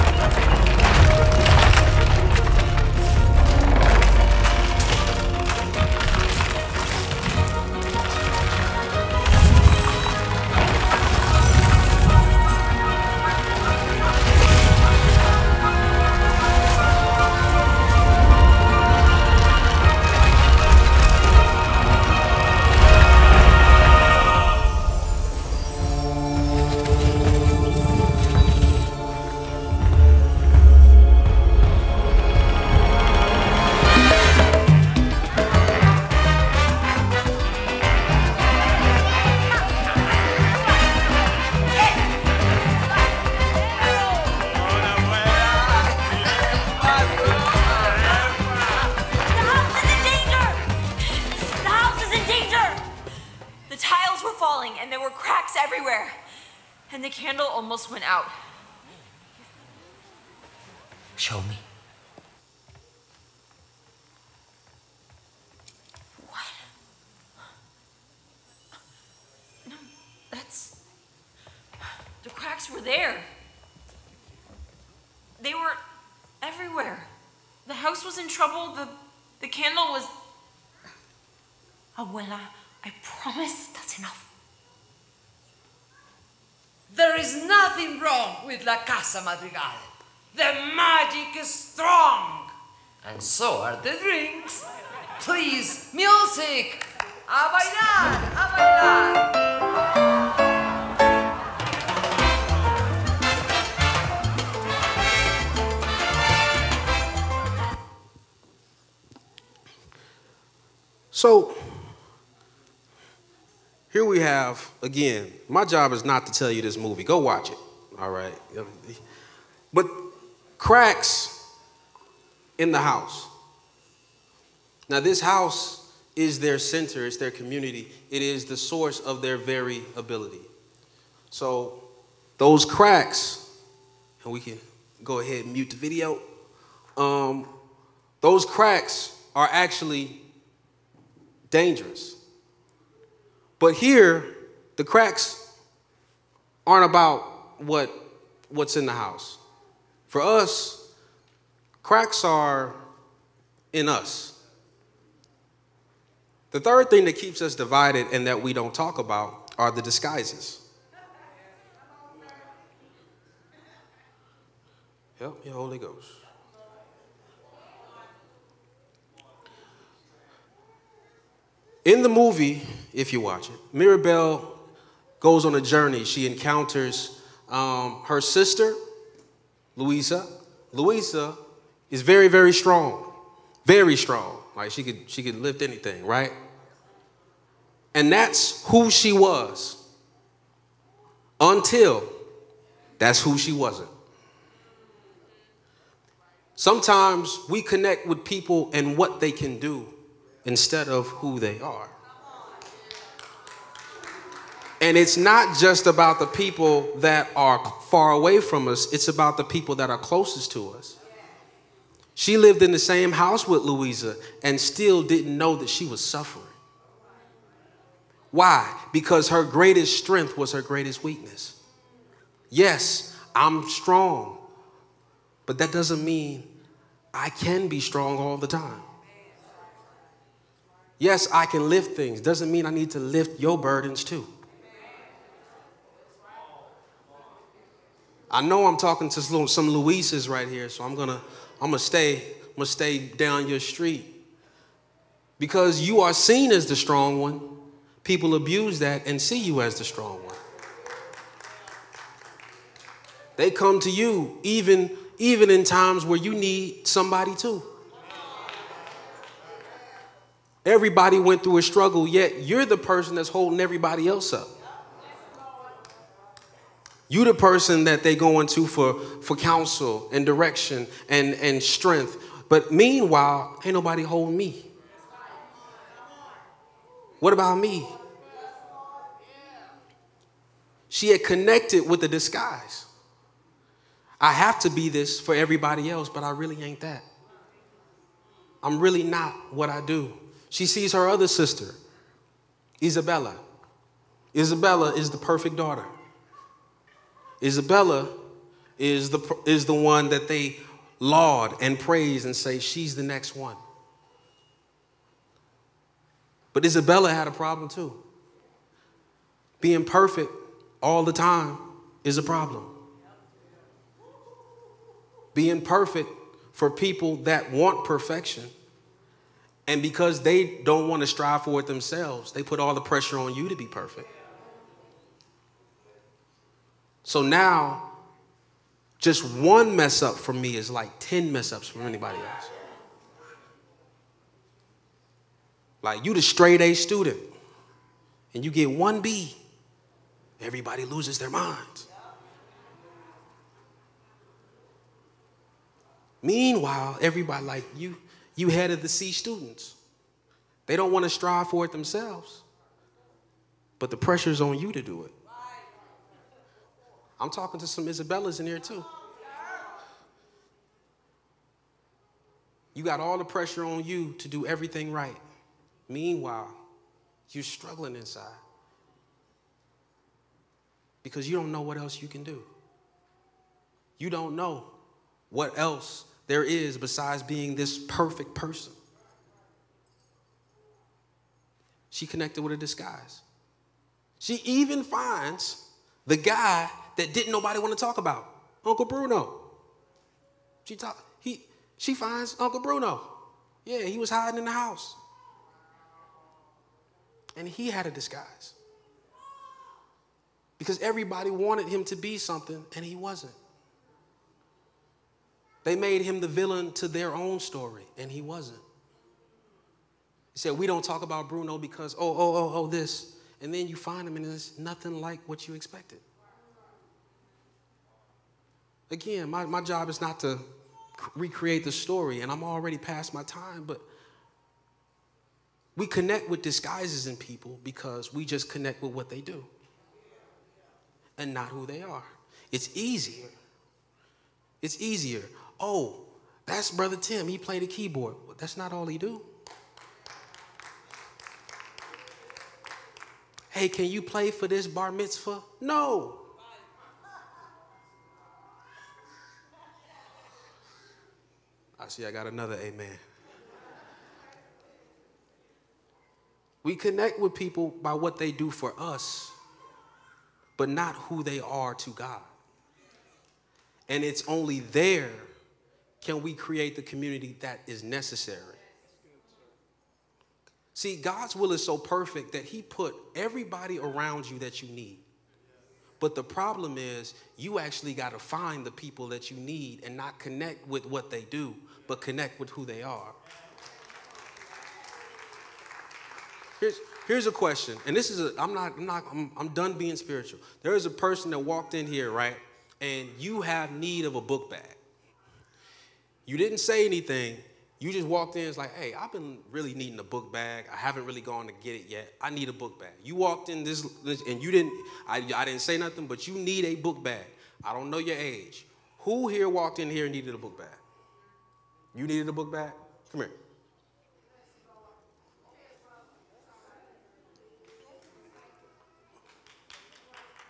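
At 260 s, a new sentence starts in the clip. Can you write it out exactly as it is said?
Everybody went through a struggle, yet you're the person that's holding everybody else up.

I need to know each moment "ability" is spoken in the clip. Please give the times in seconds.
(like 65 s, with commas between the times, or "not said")
129 s.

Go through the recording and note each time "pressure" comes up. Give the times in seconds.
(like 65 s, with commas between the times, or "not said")
322 s, 353 s, 363 s.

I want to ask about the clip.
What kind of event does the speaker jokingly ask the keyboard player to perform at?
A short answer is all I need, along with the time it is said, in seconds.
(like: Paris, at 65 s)
Bar mitzvah, at 444 s.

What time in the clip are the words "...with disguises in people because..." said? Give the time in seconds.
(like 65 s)
426 s.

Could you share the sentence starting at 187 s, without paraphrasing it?
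And that's who she was until that's who she wasn't.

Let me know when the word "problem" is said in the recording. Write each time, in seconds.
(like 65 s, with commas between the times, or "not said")
307 s, 312 s, 476 s.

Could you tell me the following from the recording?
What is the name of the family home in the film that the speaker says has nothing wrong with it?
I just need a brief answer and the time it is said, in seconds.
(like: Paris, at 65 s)
La Casa Madrigal, at 88 s.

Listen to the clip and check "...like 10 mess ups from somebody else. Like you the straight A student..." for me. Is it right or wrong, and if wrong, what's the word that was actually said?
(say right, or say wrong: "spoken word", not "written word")
wrong: "anybody", not "somebody".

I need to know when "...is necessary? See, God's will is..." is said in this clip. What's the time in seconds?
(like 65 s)
467 s.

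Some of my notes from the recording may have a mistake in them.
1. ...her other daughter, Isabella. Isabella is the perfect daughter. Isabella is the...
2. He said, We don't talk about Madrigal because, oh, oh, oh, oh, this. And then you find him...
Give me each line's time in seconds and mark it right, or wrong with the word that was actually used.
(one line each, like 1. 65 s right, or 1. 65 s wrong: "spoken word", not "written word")
1. 290 s wrong: "sister", not "daughter"
2. 410 s wrong: "Bruno", not "Madrigal".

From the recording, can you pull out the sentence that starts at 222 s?
Yes, I'm strong, but that doesn't mean I can be strong all the time.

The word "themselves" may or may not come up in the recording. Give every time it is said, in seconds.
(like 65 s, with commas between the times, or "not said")
321 s, 351 s.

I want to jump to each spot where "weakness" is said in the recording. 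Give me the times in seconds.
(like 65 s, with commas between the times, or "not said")
221 s.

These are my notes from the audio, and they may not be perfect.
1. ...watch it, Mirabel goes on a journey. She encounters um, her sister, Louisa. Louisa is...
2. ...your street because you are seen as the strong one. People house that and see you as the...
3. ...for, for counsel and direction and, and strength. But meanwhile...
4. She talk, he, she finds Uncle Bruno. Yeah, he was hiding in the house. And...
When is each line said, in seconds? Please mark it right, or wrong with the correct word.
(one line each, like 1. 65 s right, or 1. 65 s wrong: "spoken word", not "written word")
1. 173 s right
2. 243 s wrong: "abuse", not "house"
3. 268 s right
4. 390 s right.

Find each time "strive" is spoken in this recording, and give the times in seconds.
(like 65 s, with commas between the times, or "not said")
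321 s, 351 s.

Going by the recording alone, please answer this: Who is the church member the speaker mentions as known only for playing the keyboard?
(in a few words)
Brother Tim.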